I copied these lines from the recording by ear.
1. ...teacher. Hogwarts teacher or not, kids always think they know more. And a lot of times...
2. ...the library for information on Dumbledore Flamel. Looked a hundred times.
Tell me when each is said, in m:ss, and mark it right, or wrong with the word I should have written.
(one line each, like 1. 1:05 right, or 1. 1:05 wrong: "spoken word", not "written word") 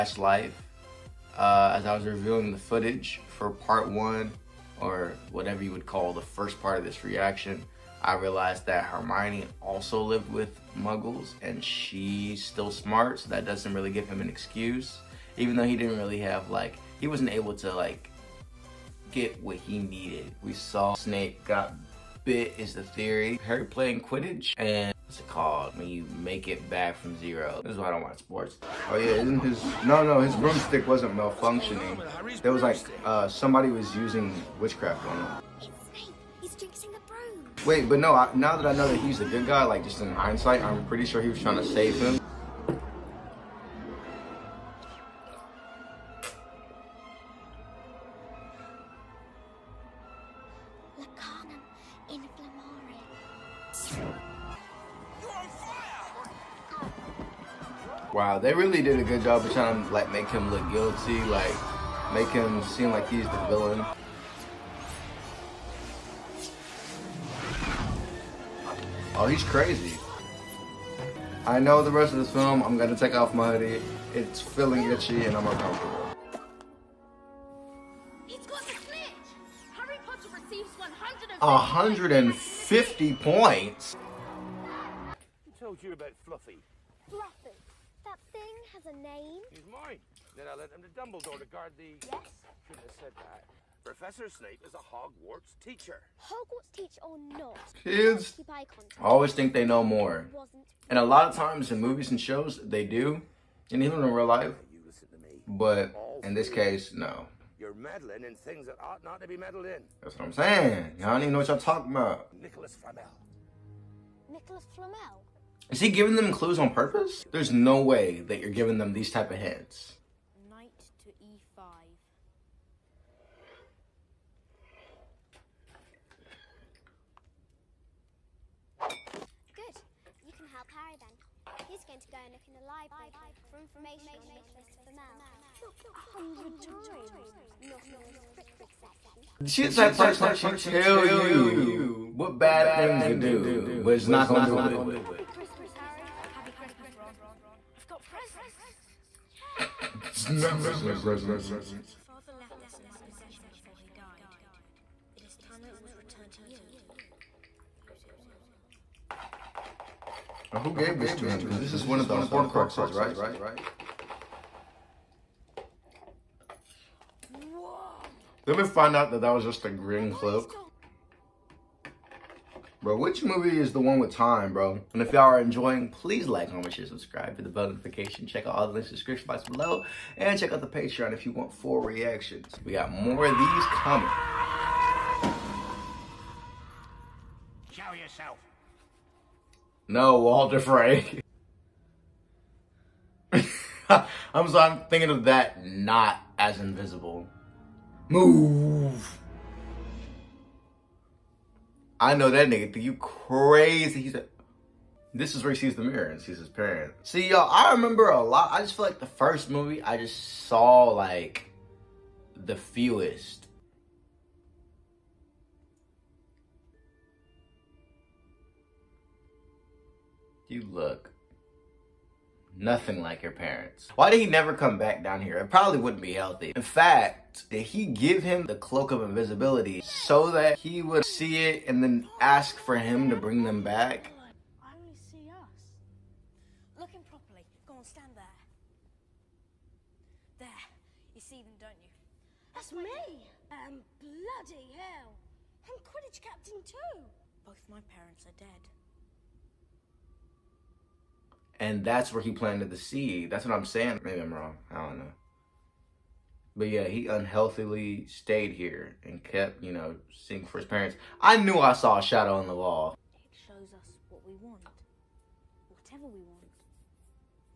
1. 1:35 right
2. 2:12 wrong: "Nicholas", not "Dumbledore".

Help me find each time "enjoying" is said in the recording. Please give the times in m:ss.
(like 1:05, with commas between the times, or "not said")
2:55.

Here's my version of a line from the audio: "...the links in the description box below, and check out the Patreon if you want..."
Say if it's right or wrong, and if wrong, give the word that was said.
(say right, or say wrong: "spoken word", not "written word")
right.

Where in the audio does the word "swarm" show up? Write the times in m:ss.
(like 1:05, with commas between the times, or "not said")
not said.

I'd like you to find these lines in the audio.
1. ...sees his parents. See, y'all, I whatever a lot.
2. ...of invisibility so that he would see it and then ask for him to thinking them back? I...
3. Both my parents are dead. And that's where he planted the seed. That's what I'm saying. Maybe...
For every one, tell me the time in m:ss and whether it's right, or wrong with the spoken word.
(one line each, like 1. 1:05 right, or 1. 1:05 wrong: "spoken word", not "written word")
1. 3:26 wrong: "remember", not "whatever"
2. 3:48 wrong: "bring", not "thinking"
3. 4:07 right.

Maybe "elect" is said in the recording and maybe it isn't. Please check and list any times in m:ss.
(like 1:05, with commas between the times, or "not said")
not said.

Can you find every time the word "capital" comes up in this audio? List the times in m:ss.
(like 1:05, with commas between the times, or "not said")
not said.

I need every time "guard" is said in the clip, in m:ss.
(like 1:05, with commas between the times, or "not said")
1:31.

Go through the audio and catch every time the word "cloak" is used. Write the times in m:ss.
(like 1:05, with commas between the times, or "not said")
2:50, 3:48.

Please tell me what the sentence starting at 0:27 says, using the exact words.
This is why I don't watch sports.